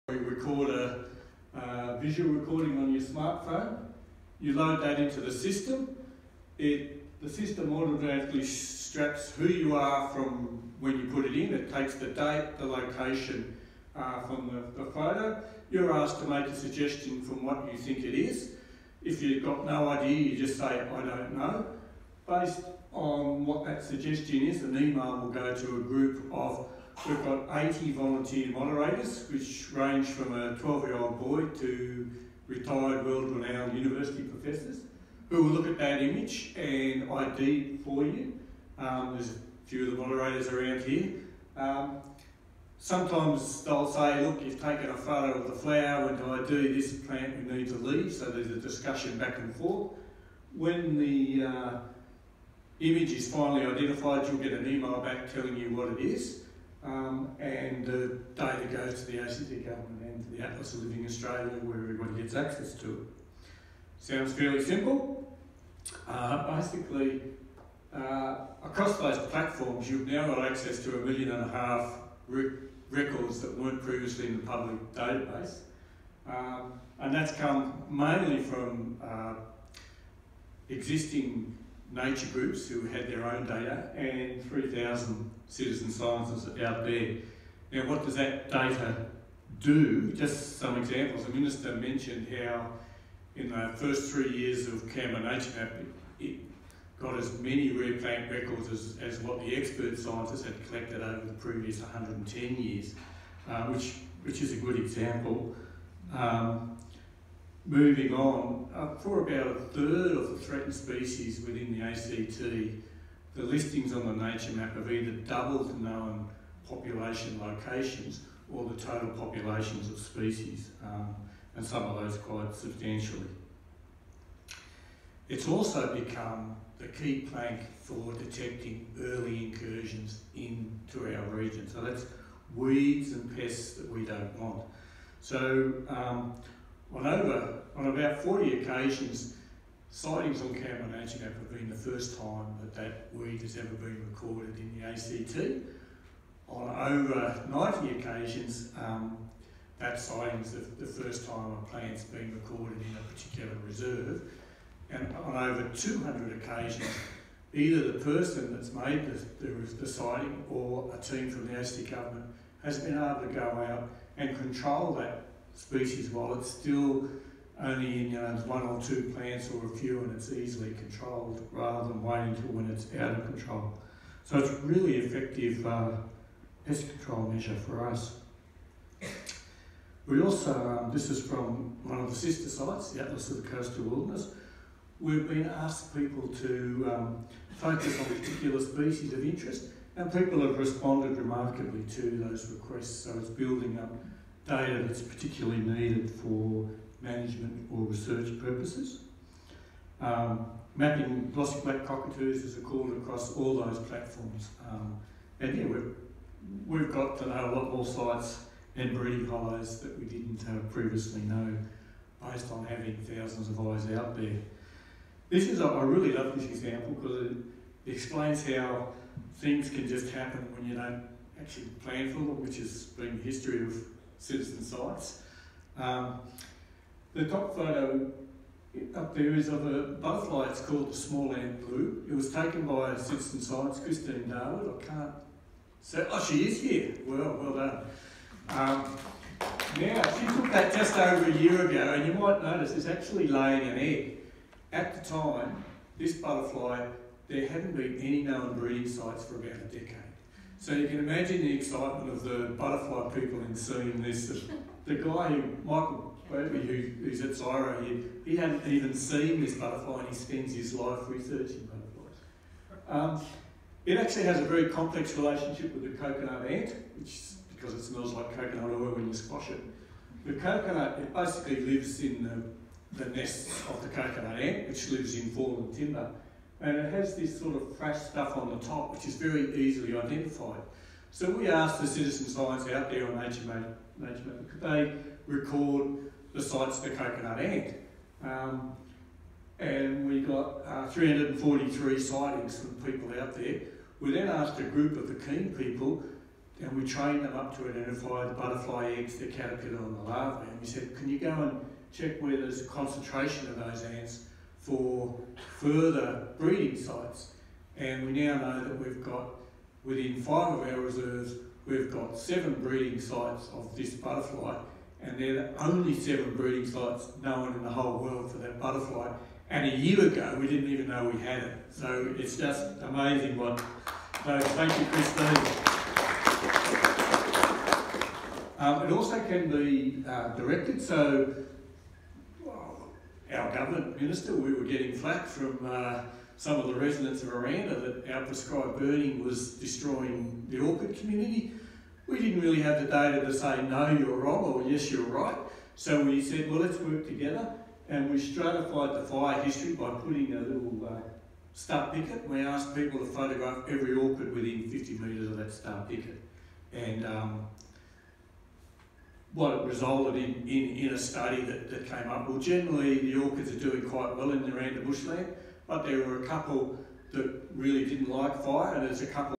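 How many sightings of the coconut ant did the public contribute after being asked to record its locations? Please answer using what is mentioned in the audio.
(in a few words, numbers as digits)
343.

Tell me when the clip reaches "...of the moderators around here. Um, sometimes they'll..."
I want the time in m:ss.
0:39.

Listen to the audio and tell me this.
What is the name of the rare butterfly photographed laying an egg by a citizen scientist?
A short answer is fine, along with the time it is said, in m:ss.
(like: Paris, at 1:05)
small Ant-blue, at 3:50.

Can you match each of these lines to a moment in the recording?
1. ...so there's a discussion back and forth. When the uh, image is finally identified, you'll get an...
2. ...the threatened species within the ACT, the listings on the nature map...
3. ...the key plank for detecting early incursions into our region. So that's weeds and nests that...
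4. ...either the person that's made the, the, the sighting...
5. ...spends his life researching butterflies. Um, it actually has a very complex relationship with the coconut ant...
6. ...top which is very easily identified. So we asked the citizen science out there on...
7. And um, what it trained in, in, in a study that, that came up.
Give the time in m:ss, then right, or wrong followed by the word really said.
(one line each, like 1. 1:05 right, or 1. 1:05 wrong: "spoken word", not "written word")
1. 0:48 right
2. 1:50 right
3. 2:06 wrong: "pests", not "nests"
4. 2:37 right
5. 4:20 right
6. 4:38 right
7. 5:56 wrong: "resulted", not "trained".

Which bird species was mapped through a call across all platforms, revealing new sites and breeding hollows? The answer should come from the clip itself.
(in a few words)
glossy black cockatoos.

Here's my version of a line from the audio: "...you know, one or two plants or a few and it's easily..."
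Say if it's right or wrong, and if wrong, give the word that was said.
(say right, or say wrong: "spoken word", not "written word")
right.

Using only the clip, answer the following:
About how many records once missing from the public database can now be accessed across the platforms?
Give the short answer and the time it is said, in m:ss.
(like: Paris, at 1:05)
a million and a half, at 1:10.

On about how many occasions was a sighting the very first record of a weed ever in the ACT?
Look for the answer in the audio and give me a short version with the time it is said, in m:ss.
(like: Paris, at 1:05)
40, at 2:18.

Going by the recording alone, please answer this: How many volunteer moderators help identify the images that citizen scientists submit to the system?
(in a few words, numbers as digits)
80.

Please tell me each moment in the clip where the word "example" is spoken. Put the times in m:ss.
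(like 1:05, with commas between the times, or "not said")
1:30, 1:44, 3:36.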